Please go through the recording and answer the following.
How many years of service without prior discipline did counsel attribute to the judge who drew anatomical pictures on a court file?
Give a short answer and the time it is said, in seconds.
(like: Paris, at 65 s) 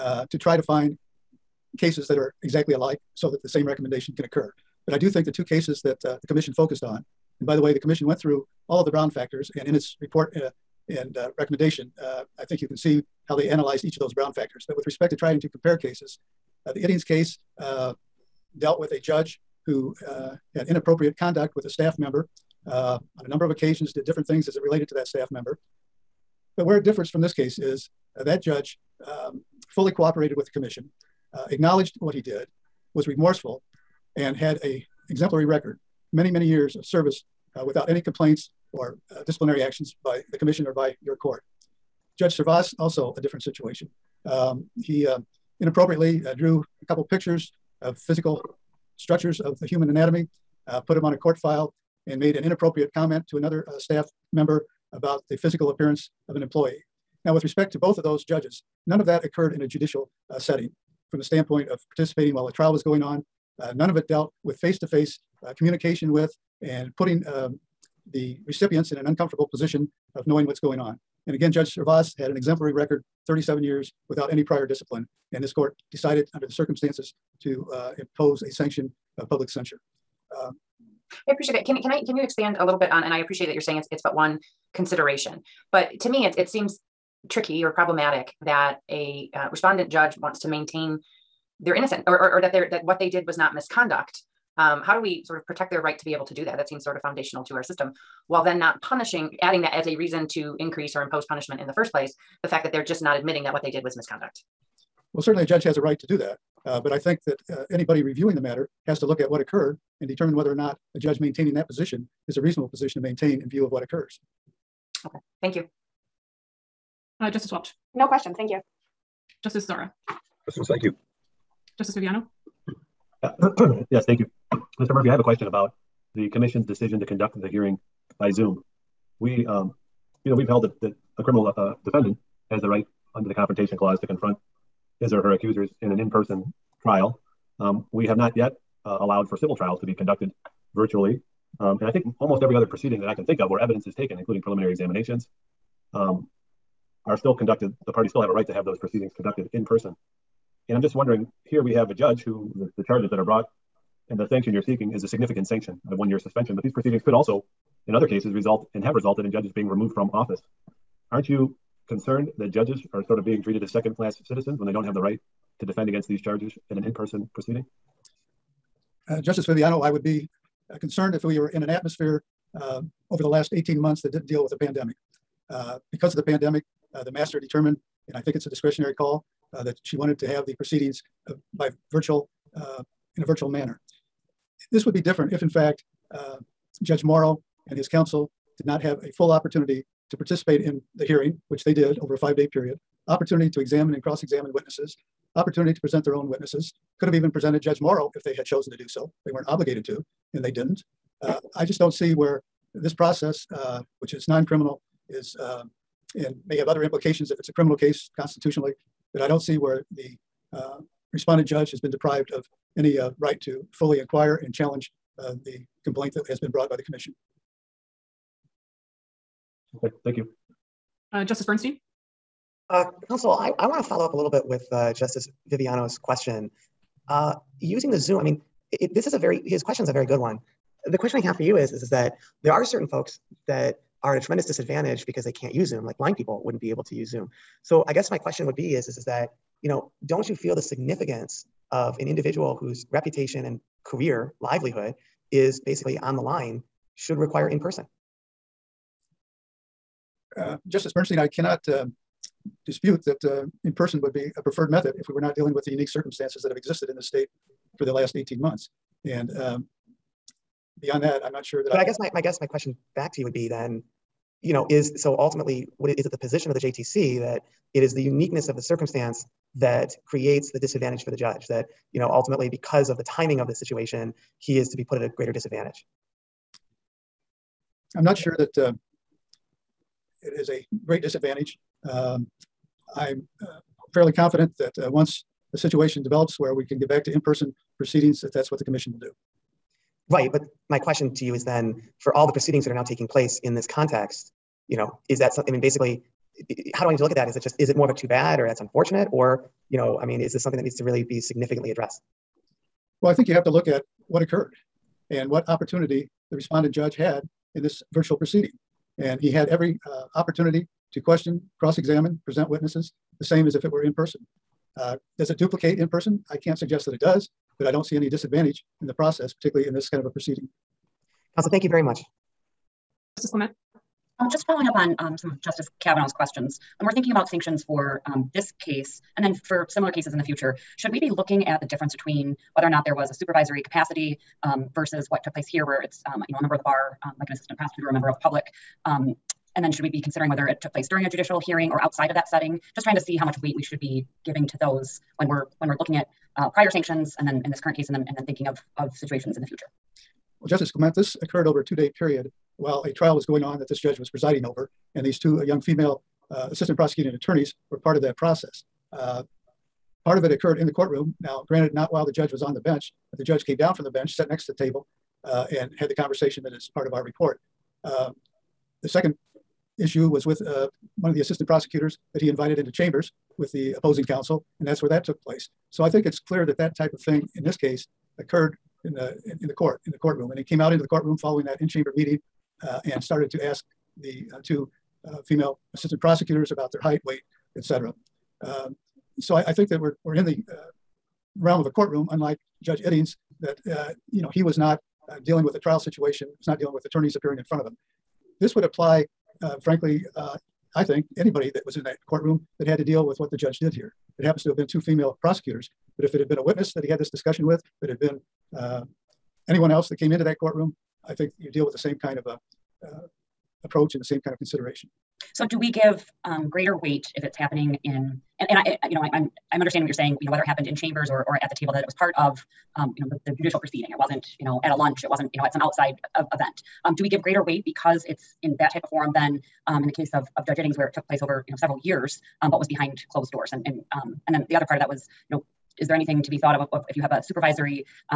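37, at 73 s.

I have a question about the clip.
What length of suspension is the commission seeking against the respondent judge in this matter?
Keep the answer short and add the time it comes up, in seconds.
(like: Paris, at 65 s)
one year, at 155 s.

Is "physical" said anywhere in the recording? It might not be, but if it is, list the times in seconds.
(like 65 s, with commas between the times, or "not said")
47 s, 55 s.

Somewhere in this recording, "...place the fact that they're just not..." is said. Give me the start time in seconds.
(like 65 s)
101 s.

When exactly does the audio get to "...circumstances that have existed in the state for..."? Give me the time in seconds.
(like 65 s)
255 s.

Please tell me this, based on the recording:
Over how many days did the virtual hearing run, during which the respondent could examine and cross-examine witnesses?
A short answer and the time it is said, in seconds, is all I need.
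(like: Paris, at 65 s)
5, at 192 s.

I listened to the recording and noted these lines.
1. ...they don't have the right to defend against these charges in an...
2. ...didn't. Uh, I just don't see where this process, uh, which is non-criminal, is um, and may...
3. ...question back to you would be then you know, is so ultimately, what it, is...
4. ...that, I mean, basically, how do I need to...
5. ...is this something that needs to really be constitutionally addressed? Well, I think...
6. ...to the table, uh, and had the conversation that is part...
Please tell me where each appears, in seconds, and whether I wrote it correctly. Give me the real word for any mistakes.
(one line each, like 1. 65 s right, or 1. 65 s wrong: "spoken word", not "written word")
1. 164 s right
2. 200 s right
3. 262 s right
4. 295 s right
5. 300 s wrong: "significantly", not "constitutionally"
6. 364 s right.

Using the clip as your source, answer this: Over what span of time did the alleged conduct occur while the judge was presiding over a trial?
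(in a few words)
2 days.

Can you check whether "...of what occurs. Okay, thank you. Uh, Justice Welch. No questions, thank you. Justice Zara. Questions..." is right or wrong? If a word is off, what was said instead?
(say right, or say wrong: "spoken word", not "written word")
right.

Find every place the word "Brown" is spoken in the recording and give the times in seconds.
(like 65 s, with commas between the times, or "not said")
8 s, 14 s.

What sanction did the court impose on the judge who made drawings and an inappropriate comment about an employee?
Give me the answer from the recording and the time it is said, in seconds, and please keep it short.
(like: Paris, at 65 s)
public censure, at 79 s.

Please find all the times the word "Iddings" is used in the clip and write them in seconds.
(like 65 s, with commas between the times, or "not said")
16 s, 392 s, 430 s.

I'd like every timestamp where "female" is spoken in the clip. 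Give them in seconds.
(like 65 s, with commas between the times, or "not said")
355 s, 385 s, 404 s.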